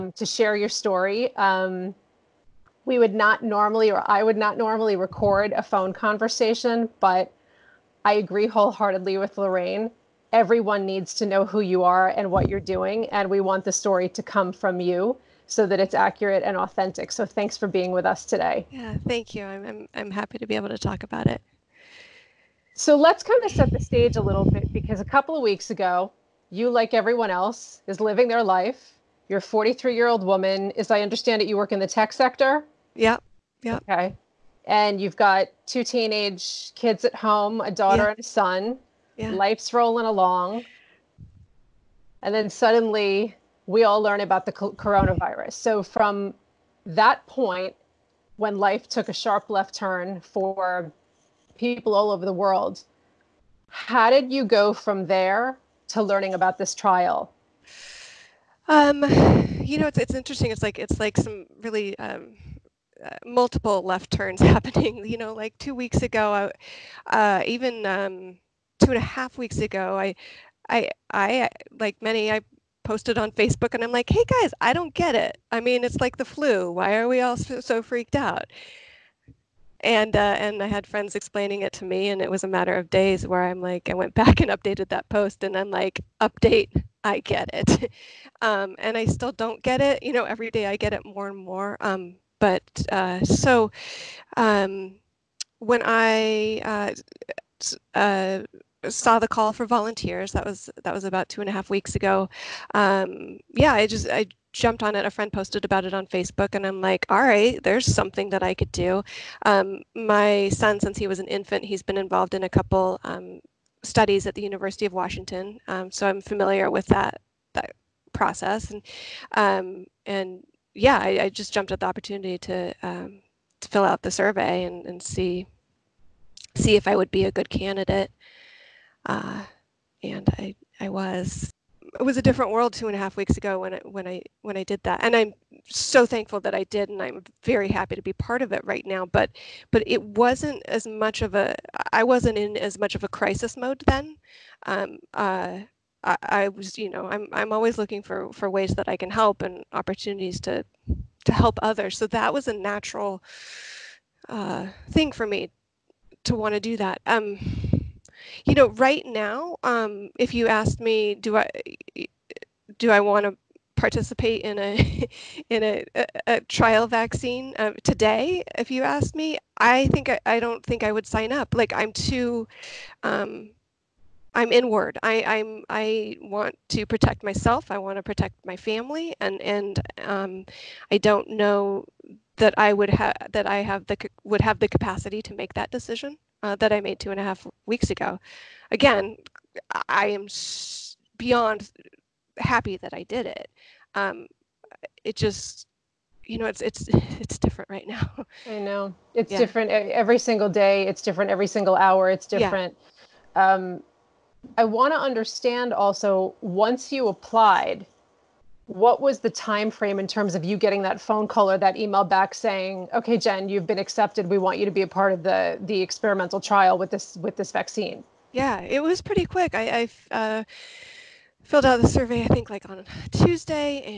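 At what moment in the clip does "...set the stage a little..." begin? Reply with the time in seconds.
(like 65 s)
23 s.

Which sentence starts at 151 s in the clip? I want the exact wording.
So that was a natural uh, thing for me to want to do that.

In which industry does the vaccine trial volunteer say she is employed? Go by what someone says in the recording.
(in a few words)
Tech sector.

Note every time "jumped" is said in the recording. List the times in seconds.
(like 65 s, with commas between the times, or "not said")
104 s, 121 s.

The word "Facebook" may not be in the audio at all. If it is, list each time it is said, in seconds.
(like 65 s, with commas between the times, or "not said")
73 s, 106 s.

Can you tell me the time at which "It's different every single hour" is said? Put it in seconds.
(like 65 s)
200 s.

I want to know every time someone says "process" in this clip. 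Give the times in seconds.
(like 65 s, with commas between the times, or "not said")
118 s.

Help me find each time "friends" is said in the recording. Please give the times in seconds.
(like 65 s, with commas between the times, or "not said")
80 s, 105 s.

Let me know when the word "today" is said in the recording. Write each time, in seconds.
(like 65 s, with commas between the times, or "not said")
18 s, 167 s.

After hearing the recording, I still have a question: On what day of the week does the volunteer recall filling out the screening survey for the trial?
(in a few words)
Tuesday.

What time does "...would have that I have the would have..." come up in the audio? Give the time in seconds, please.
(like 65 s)
182 s.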